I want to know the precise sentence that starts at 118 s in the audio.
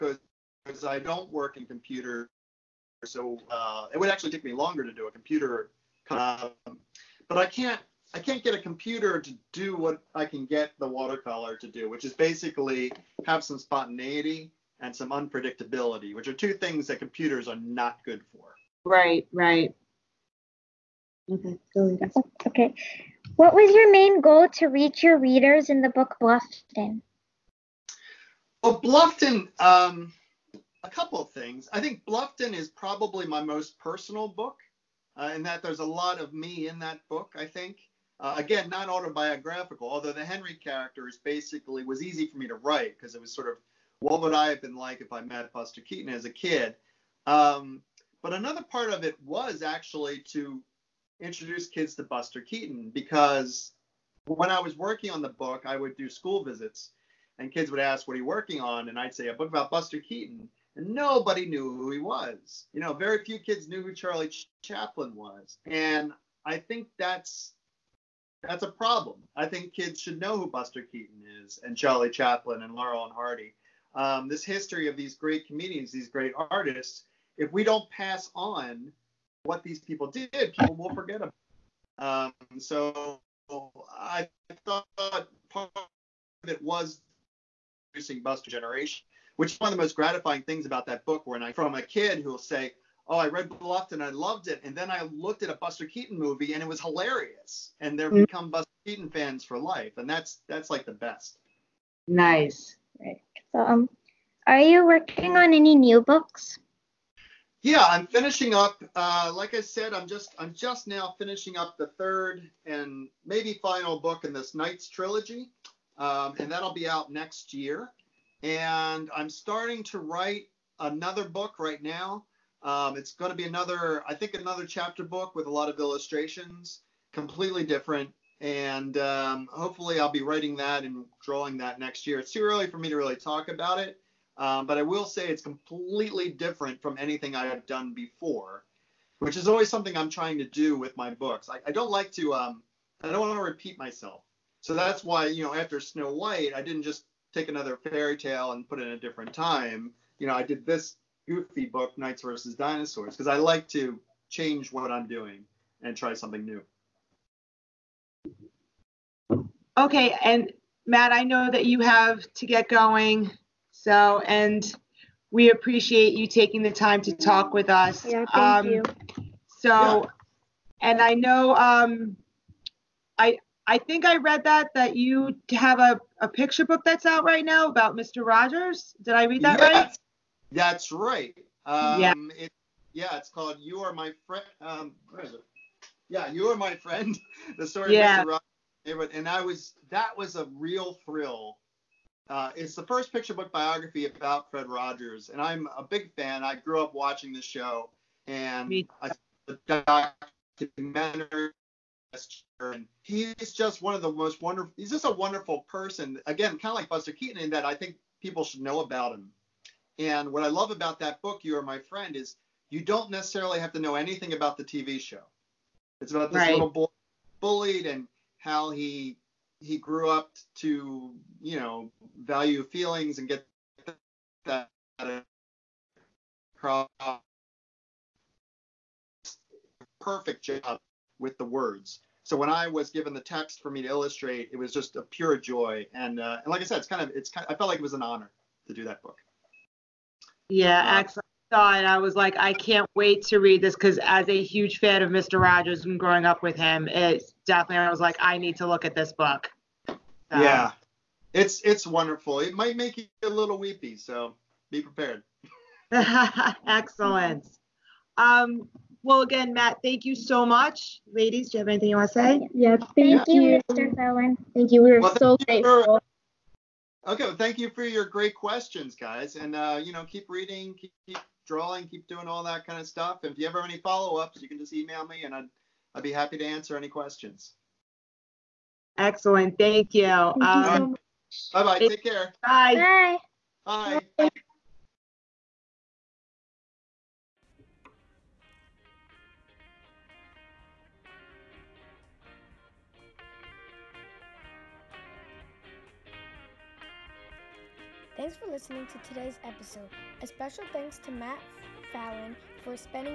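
And I'm starting to write another book right now.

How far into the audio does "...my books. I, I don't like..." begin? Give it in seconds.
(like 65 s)
140 s.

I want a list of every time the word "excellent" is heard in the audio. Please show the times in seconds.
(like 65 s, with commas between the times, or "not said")
240 s, 256 s, 278 s.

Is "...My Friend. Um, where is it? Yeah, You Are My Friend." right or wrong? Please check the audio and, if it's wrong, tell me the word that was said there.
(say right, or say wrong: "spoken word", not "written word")
right.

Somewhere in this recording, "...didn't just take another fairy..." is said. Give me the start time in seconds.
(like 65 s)
146 s.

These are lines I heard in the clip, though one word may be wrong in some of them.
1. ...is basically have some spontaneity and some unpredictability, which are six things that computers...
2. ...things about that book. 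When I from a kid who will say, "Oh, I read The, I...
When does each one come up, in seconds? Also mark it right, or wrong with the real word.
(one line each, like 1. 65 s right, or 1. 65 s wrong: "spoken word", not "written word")
1. 12 s wrong: "two", not "six"
2. 90 s wrong: "Bluffton", not "The".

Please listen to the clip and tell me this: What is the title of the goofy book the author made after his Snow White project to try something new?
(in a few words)
Knights versus Dinosaurs.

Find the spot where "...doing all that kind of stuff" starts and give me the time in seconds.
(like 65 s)
272 s.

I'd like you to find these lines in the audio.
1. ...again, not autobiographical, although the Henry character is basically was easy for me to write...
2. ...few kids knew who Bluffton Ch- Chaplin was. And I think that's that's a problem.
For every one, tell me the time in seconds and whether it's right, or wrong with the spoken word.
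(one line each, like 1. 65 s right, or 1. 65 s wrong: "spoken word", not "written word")
1. 38 s right
2. 63 s wrong: "Charlie", not "Bluffton".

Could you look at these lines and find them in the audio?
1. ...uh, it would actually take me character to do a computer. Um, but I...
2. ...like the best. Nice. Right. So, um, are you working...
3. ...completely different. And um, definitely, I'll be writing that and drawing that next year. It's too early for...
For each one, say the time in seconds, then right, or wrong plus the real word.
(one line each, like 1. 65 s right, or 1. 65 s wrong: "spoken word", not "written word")
1. 3 s wrong: "longer", not "character"
2. 100 s right
3. 127 s wrong: "hopefully", not "definitely".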